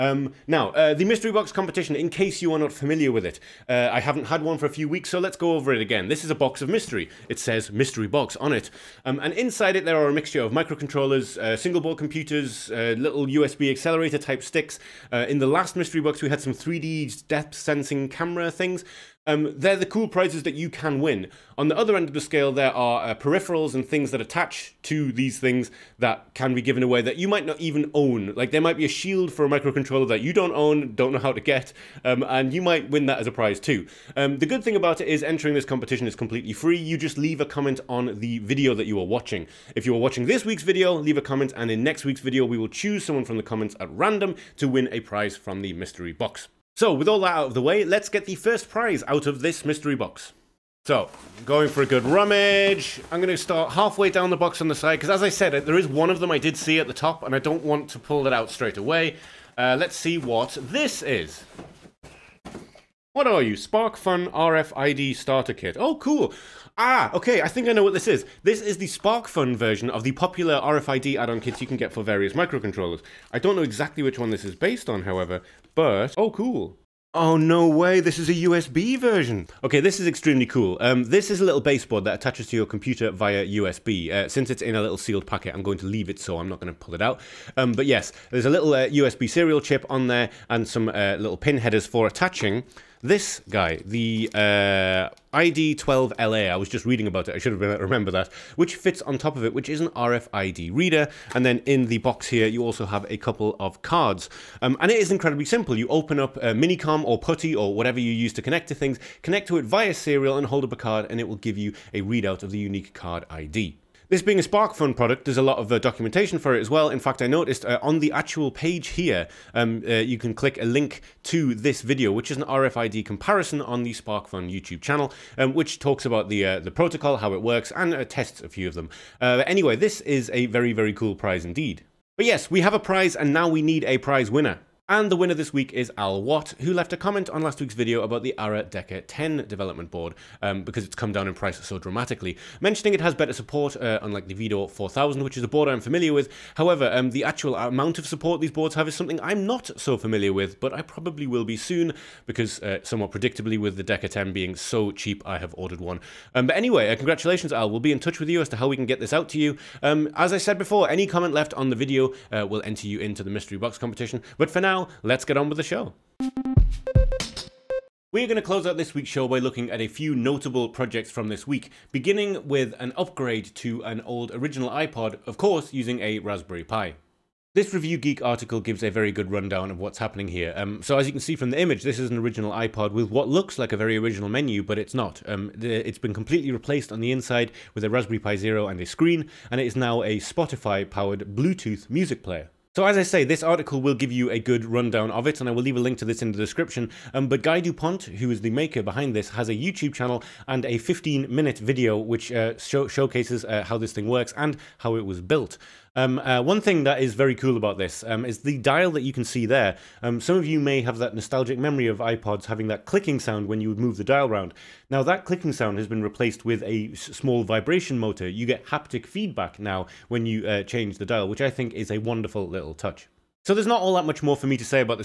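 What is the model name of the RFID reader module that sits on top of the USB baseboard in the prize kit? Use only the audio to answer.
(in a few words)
ID12LA.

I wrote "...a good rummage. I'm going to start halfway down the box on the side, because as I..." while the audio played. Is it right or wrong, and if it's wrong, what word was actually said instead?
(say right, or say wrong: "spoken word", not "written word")
right.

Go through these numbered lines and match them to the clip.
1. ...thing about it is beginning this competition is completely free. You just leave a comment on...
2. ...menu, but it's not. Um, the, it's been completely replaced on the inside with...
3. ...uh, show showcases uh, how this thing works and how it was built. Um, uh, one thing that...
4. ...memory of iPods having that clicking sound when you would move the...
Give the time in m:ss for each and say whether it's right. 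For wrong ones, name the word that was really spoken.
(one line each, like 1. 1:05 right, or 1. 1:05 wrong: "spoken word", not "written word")
1. 0:34 wrong: "entering", not "beginning"
2. 3:04 right
3. 3:22 right
4. 3:31 right.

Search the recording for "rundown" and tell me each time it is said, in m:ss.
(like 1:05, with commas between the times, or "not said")
2:59, 3:14.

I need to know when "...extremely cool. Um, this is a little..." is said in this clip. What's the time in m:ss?
1:20.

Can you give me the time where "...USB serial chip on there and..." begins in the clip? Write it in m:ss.
1:28.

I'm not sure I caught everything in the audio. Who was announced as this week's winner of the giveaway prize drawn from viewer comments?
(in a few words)
Al Watt.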